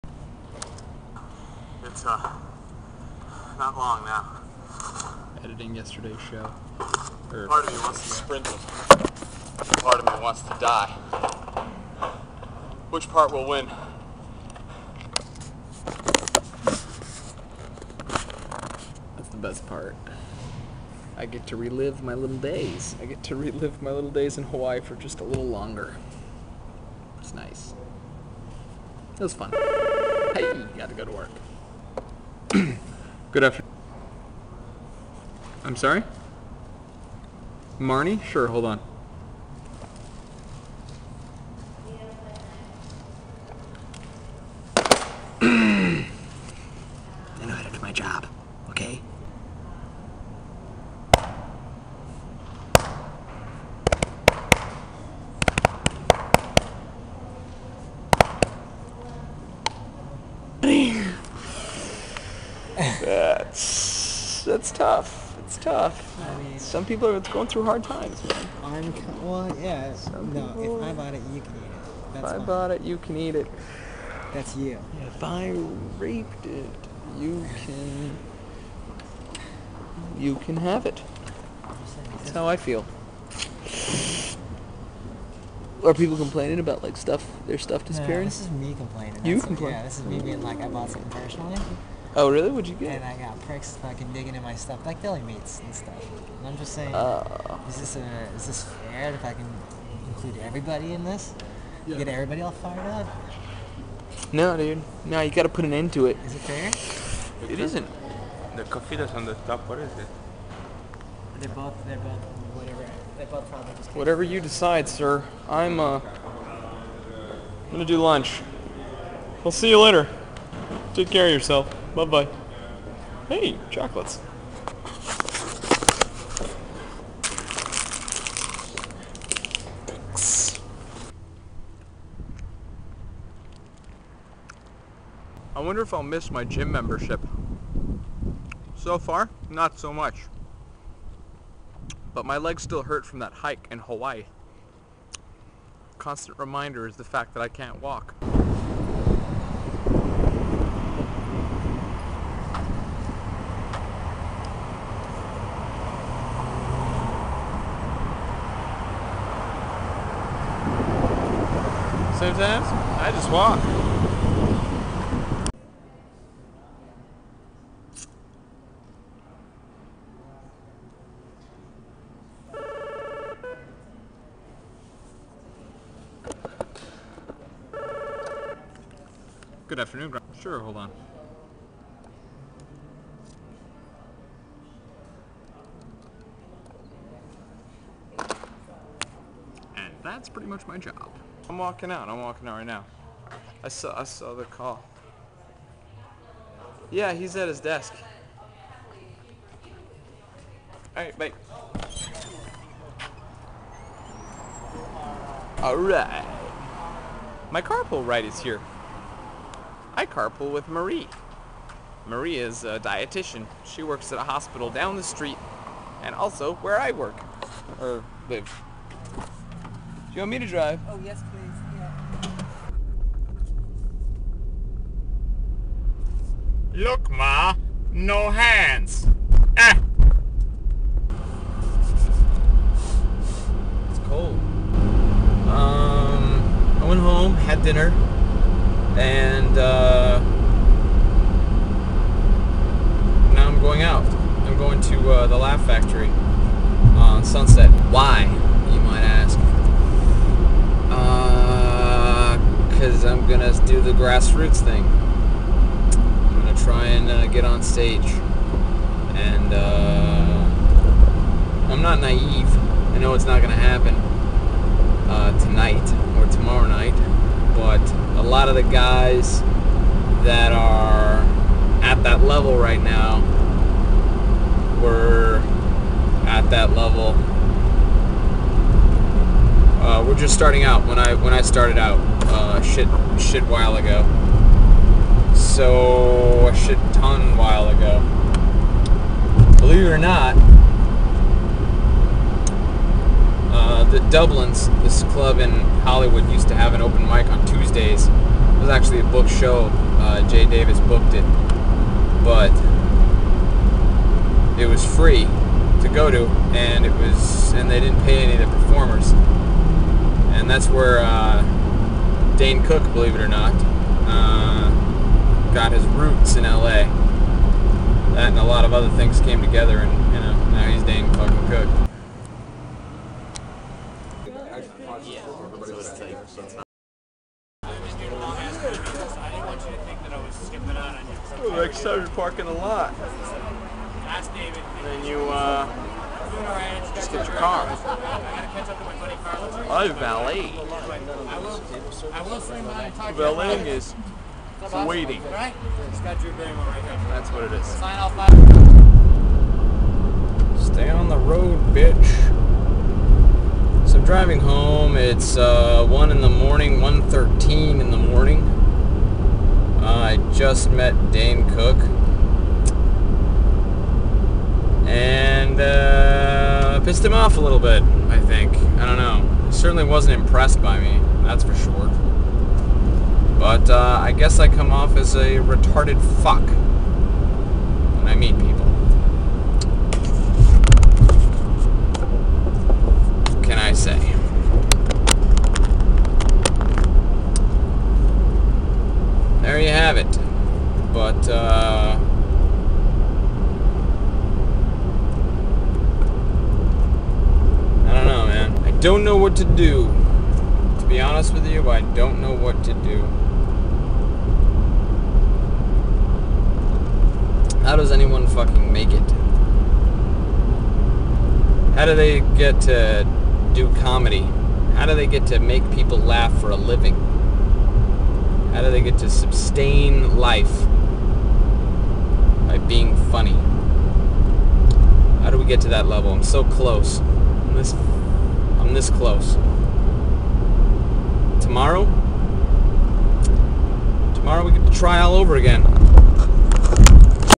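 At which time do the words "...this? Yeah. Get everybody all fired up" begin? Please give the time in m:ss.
1:41.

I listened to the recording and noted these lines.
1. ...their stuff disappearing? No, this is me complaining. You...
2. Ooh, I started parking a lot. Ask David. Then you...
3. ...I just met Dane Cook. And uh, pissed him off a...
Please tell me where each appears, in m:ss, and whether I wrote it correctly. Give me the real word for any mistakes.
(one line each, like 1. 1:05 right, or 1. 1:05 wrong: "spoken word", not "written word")
1. 1:27 right
2. 5:31 right
3. 6:00 right.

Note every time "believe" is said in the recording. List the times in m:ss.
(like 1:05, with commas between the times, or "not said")
4:49, 5:12.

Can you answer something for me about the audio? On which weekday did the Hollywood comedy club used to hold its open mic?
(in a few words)
Tuesdays.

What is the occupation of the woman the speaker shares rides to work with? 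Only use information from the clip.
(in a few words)
Dietitian.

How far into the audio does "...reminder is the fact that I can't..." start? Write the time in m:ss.
2:26.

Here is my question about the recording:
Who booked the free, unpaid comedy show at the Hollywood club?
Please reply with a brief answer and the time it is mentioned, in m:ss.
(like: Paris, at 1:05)
Jay Davis, at 5:00.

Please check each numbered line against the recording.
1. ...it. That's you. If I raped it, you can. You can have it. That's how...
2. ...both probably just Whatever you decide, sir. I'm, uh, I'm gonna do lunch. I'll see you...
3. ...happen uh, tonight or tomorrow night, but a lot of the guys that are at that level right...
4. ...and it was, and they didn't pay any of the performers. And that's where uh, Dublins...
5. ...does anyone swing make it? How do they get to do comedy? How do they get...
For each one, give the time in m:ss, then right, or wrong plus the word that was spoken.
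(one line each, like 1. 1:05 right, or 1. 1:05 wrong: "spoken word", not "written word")
1. 1:13 right
2. 1:53 right
3. 4:23 right
4. 5:06 wrong: "Dane", not "Dublins"
5. 6:47 wrong: "fucking", not "swing".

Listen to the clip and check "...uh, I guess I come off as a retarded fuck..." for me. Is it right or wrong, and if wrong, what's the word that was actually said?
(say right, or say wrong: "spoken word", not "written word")
right.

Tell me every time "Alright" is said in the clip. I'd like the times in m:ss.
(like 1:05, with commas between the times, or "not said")
3:20, 3:25.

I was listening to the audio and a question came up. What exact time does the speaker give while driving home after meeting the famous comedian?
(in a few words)
1:13 a.m.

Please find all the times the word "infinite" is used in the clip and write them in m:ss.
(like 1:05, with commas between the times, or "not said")
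not said.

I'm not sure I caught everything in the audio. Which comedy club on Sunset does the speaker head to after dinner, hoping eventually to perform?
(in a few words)
The Laugh Factory.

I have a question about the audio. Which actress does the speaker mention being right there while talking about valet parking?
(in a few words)
Drew Barrymore.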